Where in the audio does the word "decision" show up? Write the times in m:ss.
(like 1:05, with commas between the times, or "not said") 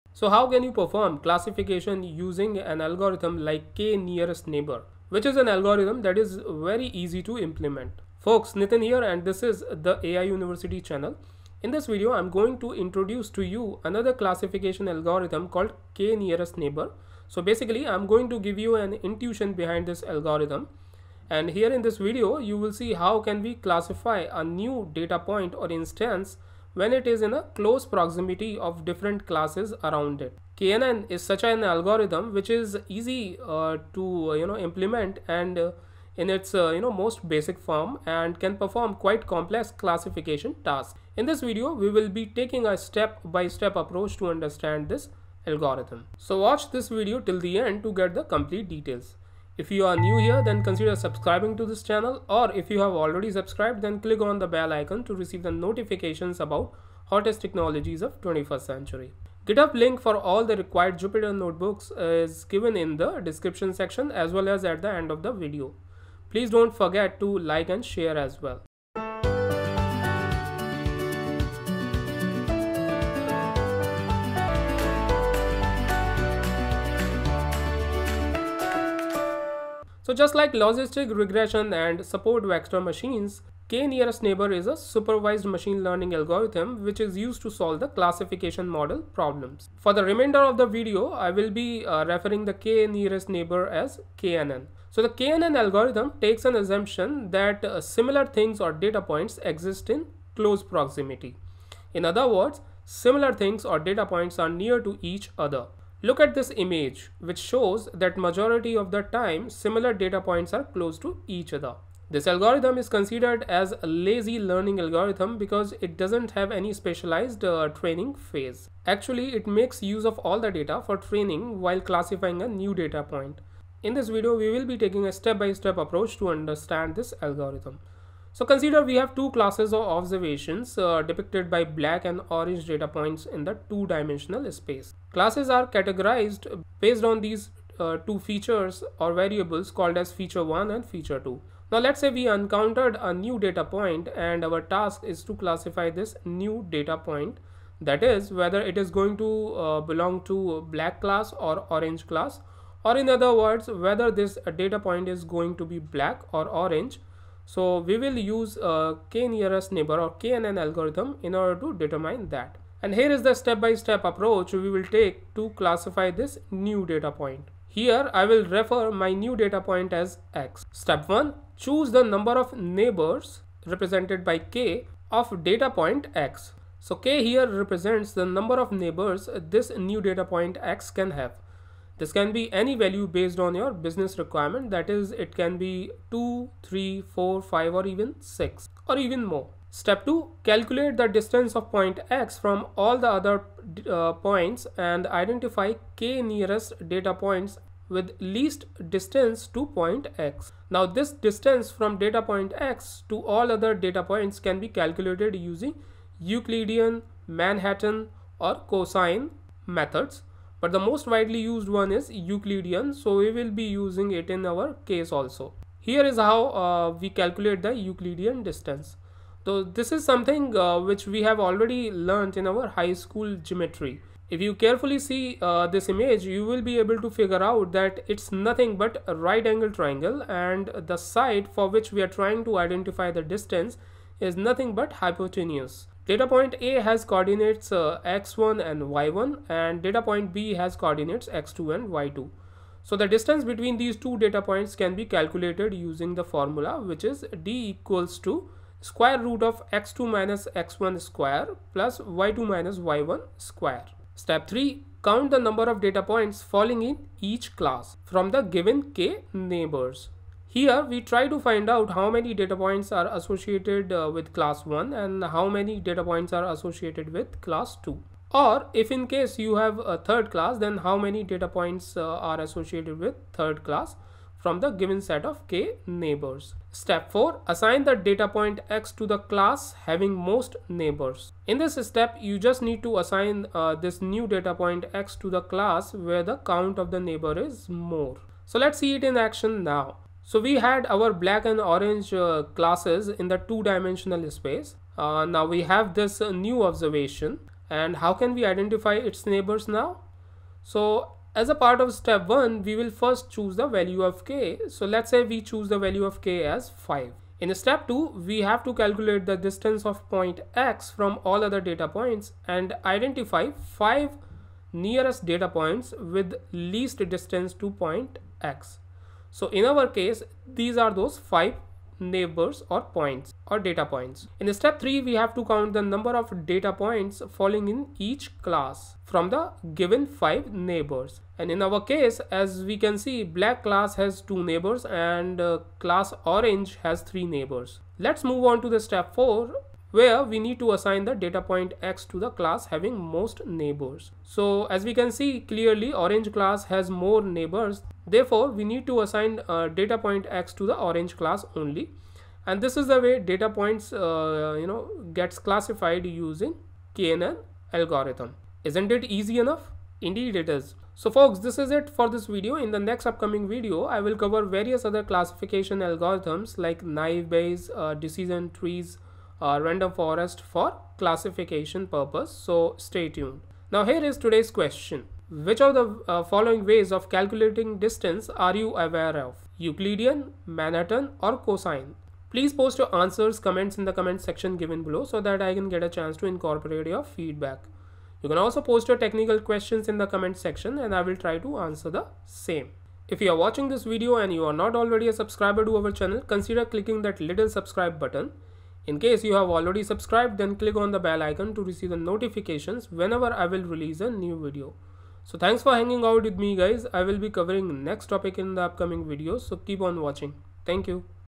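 6:07.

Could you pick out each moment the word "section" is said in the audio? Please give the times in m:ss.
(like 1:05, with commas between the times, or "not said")
1:03, 6:24, 6:30.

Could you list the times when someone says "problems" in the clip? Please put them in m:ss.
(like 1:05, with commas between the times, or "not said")
1:29.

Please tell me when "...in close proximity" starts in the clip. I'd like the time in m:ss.
1:39.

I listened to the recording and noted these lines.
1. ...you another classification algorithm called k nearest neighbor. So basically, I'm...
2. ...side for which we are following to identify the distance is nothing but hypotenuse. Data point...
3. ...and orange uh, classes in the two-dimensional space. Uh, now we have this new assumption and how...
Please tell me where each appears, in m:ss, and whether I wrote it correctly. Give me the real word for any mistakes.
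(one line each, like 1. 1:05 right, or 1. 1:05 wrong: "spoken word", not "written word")
1. 0:13 right
2. 3:50 wrong: "trying", not "following"
3. 4:51 wrong: "observation", not "assumption".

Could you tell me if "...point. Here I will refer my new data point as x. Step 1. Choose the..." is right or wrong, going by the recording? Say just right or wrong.
right.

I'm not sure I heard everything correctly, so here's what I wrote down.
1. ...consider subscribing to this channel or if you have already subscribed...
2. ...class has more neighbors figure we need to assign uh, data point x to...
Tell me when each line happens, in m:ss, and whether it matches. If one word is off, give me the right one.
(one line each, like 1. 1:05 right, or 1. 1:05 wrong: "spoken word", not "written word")
1. 0:50 right
2. 5:46 wrong: "therefore", not "figure".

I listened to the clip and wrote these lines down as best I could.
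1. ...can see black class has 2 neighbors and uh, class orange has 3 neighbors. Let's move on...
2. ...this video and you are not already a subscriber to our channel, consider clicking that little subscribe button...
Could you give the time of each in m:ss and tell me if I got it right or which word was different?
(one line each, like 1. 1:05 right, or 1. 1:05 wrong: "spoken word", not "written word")
1. 5:32 right
2. 6:33 right.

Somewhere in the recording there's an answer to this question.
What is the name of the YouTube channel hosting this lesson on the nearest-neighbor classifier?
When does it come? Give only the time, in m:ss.
0:10.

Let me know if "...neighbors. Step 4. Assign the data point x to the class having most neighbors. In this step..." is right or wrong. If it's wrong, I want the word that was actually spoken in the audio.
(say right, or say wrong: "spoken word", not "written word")
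right.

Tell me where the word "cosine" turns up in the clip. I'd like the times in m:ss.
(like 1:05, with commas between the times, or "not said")
3:28, 6:21.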